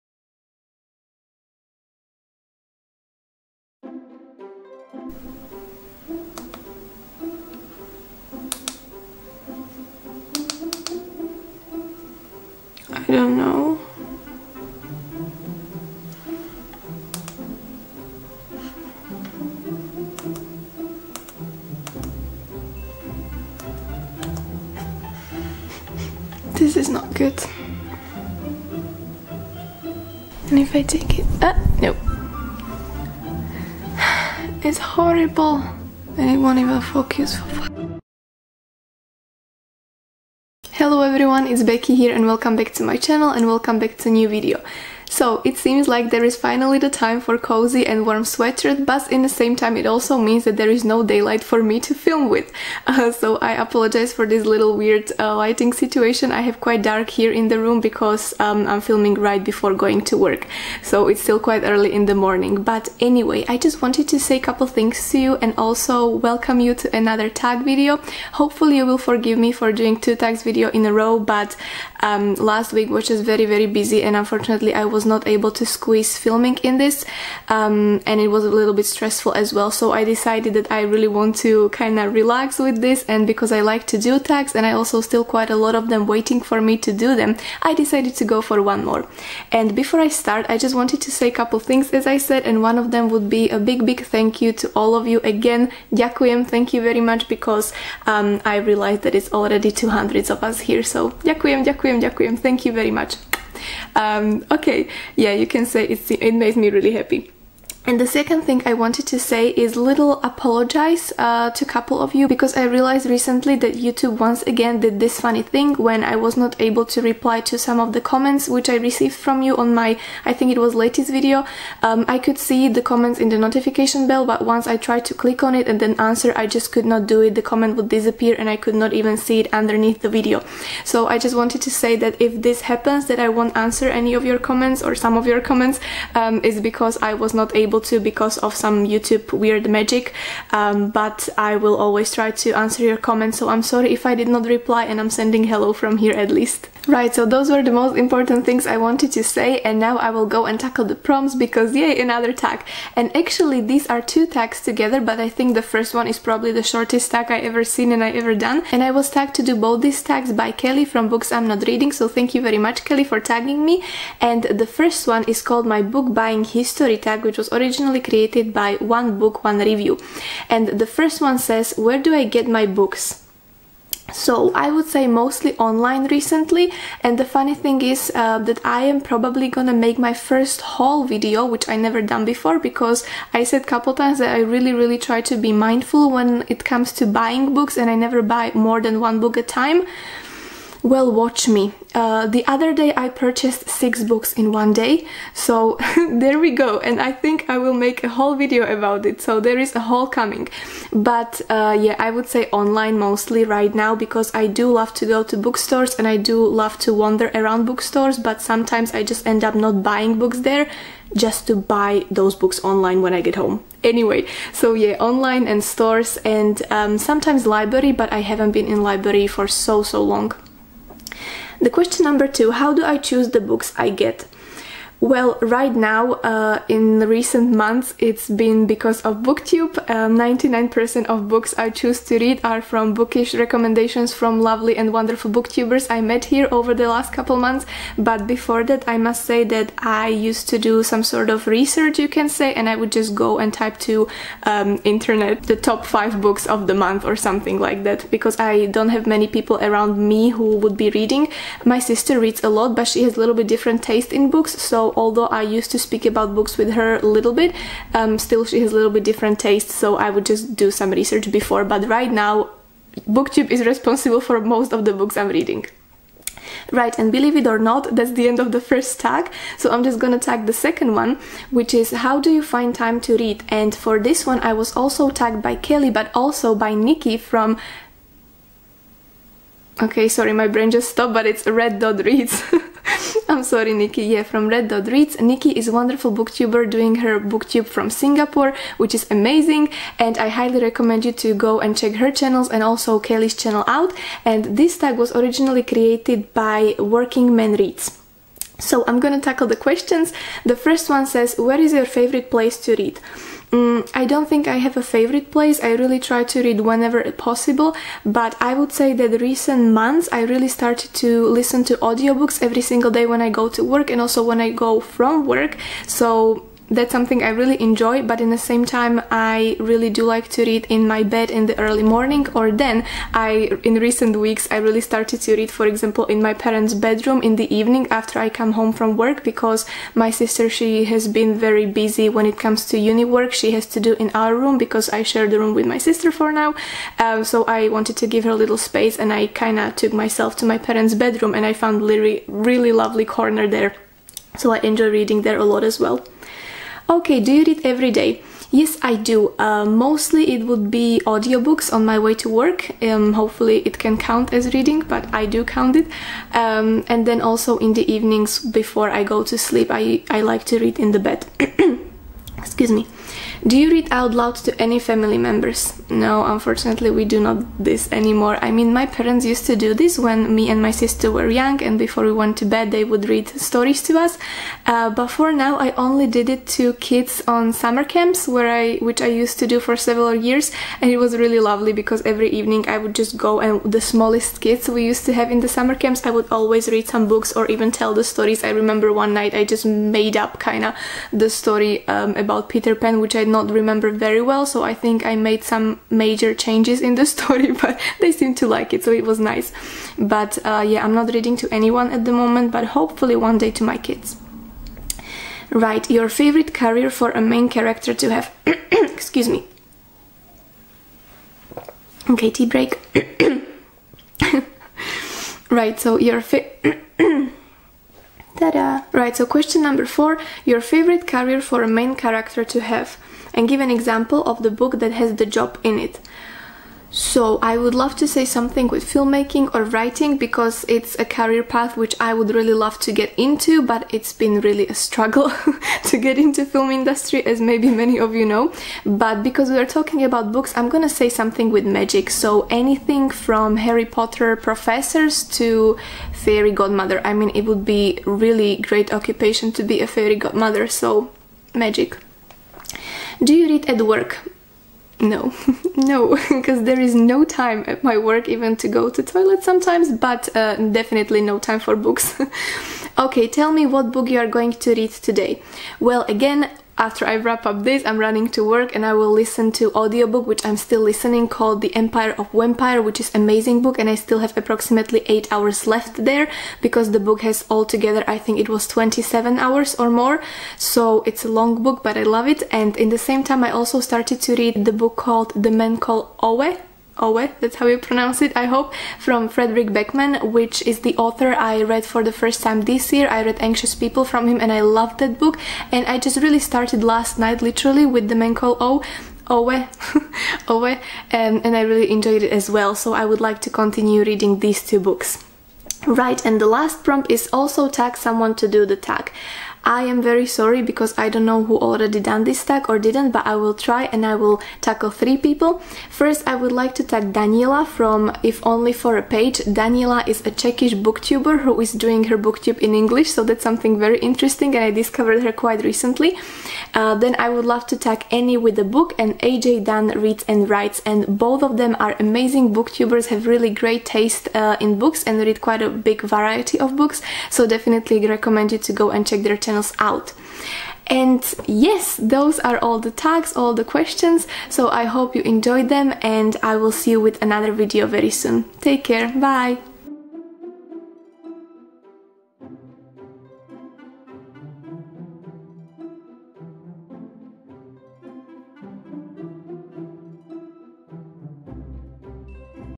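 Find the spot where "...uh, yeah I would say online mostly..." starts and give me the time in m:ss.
3:21.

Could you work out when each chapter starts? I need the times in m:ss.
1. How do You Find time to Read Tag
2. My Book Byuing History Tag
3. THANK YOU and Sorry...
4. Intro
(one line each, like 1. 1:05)
1. 4:26
2. 2:27
3. 1:30
4. 0:40.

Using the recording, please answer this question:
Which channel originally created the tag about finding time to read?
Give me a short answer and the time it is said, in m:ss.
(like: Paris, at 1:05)
Working Man Reads, at 4:56.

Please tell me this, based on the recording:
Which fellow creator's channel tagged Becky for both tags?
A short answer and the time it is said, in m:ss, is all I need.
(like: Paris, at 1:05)
Books I'm Not Reading, at 2:41.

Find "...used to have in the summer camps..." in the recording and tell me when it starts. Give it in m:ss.
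6:24.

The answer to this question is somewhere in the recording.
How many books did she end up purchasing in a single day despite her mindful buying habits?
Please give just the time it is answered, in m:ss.
3:13.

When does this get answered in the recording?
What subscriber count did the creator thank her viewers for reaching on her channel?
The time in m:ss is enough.
1:39.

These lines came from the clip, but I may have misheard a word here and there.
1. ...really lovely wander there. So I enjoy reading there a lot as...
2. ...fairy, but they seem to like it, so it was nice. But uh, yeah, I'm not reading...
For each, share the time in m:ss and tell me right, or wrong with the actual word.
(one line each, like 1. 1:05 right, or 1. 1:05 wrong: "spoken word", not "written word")
1. 5:42 wrong: "corner", not "wander"
2. 6:37 wrong: "story", not "fairy".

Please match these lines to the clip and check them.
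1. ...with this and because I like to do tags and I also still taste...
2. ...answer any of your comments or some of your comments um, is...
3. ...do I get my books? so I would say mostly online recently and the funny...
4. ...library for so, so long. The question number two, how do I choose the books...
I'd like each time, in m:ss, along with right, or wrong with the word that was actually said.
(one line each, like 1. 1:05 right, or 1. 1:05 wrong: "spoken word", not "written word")
1. 1:22 wrong: "quite", not "taste"
2. 2:13 right
3. 2:52 right
4. 3:38 right.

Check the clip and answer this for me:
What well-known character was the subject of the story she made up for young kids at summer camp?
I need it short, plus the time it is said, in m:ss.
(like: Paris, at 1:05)
Peter Pan, at 6:32.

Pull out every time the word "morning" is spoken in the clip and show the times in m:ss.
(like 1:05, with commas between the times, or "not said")
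1:02, 5:21.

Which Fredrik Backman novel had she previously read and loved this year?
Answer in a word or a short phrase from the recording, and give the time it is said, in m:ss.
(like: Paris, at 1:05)
Anxious People, at 8:13.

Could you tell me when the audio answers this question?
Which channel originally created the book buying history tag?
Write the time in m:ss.
2:48.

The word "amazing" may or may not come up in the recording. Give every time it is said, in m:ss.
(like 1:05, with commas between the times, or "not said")
4:49, 7:53, 8:51.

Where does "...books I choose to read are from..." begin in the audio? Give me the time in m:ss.
3:51.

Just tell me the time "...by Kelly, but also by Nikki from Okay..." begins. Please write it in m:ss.
4:35.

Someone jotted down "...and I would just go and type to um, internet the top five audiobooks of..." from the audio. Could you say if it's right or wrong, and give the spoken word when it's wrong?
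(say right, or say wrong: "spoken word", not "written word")
wrong: "books", not "audiobooks".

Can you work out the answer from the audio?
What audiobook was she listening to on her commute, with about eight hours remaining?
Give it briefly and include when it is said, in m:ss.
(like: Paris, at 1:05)
The Empire of Vampire, at 7:51.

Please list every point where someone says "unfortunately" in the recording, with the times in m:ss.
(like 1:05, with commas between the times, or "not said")
1:14, 6:06.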